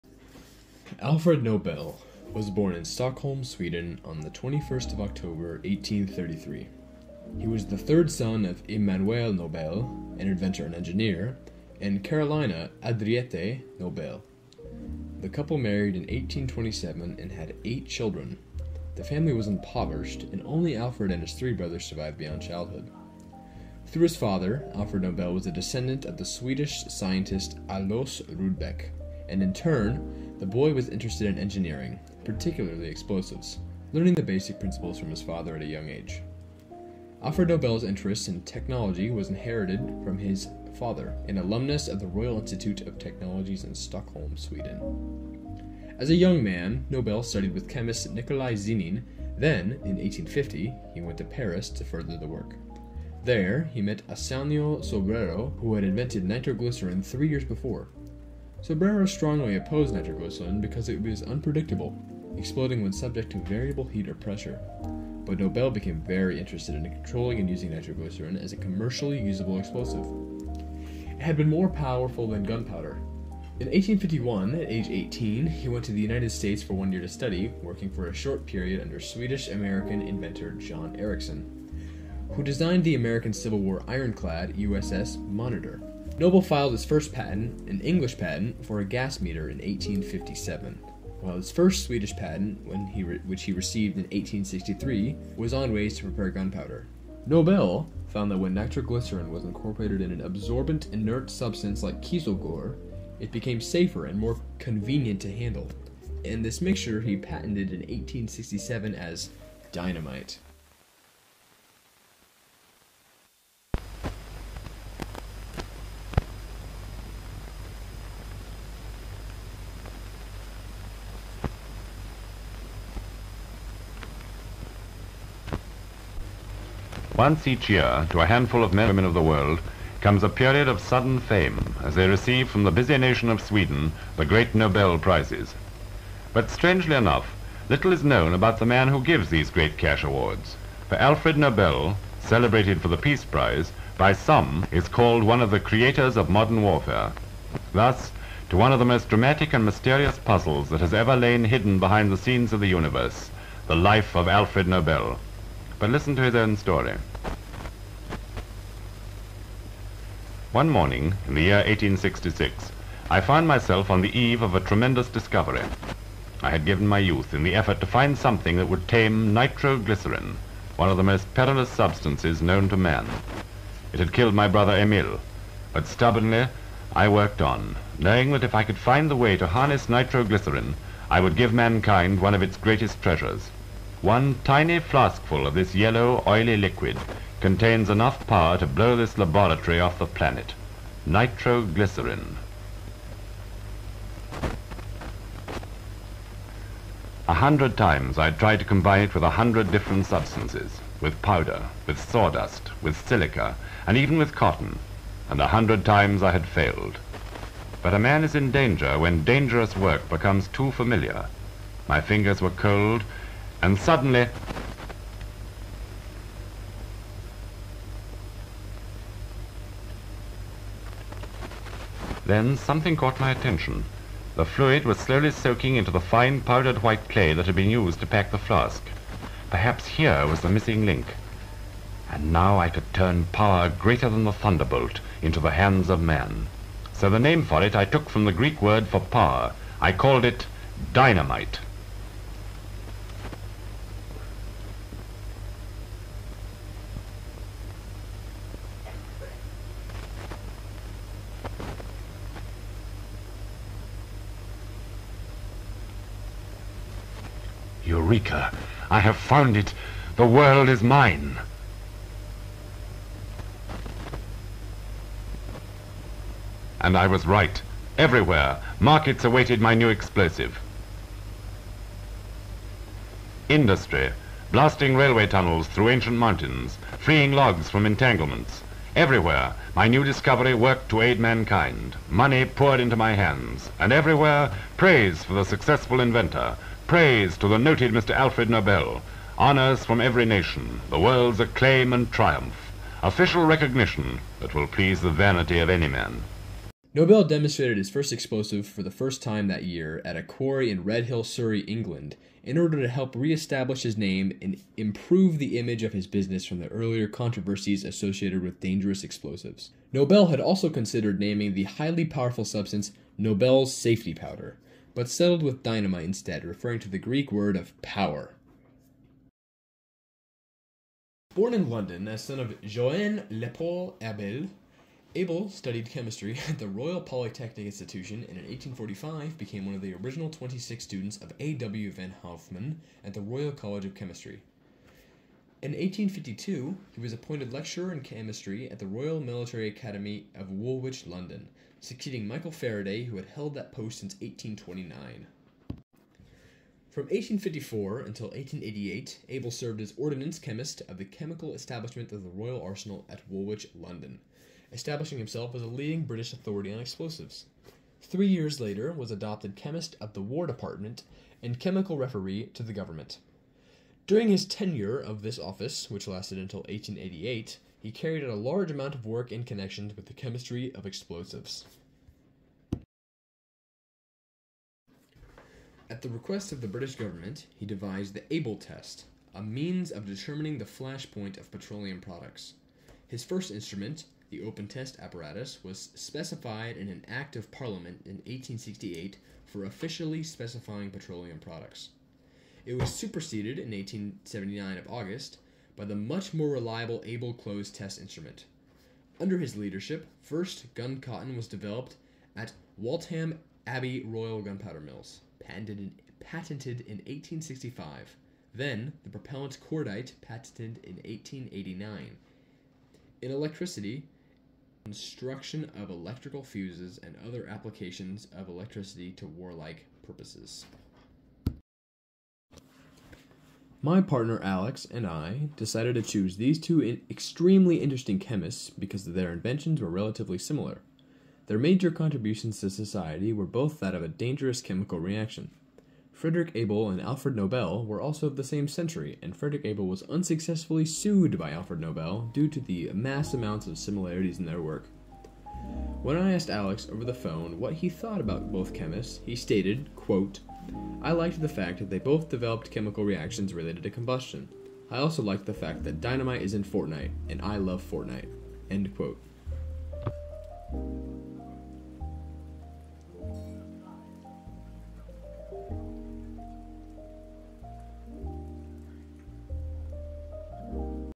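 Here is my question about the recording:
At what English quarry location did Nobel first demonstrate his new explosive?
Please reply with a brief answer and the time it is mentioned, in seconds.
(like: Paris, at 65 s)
Redhill, Surrey, at 300 s.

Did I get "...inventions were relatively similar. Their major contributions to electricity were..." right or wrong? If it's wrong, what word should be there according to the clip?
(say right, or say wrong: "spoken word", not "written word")
wrong: "society", not "electricity".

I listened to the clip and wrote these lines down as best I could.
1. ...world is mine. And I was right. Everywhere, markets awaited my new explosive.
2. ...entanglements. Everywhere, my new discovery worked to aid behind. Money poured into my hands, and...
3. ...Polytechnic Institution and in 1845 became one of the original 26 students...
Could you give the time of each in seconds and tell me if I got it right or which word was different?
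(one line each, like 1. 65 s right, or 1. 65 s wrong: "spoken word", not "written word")
1. 260 s right
2. 277 s wrong: "mankind", not "behind"
3. 326 s right.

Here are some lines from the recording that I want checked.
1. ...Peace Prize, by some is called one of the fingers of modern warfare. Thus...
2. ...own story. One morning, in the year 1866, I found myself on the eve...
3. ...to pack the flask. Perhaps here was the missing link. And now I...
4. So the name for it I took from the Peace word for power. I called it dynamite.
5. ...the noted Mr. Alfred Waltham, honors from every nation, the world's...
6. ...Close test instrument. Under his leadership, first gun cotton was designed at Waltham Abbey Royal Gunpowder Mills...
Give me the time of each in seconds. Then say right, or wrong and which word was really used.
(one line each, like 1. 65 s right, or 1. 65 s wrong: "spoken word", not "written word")
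1. 142 s wrong: "creators", not "fingers"
2. 156 s right
3. 227 s right
4. 236 s wrong: "Greek", not "Peace"
5. 287 s wrong: "Nobel", not "Waltham"
6. 397 s wrong: "developed", not "designed".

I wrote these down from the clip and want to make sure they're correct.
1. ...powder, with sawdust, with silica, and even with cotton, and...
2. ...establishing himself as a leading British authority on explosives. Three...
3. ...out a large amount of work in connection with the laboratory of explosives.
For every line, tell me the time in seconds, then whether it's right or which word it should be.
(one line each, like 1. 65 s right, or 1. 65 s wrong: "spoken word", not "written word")
1. 201 s right
2. 354 s right
3. 368 s wrong: "chemistry", not "laboratory".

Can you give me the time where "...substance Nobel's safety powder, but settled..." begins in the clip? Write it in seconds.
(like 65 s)
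312 s.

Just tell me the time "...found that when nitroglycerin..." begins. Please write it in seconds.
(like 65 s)
98 s.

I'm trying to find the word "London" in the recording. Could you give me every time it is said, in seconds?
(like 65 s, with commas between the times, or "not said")
321 s, 341 s, 353 s.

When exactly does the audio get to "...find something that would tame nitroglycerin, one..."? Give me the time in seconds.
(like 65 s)
167 s.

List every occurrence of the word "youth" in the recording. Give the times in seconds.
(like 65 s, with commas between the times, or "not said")
166 s.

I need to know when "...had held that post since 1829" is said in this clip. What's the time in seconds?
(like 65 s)
343 s.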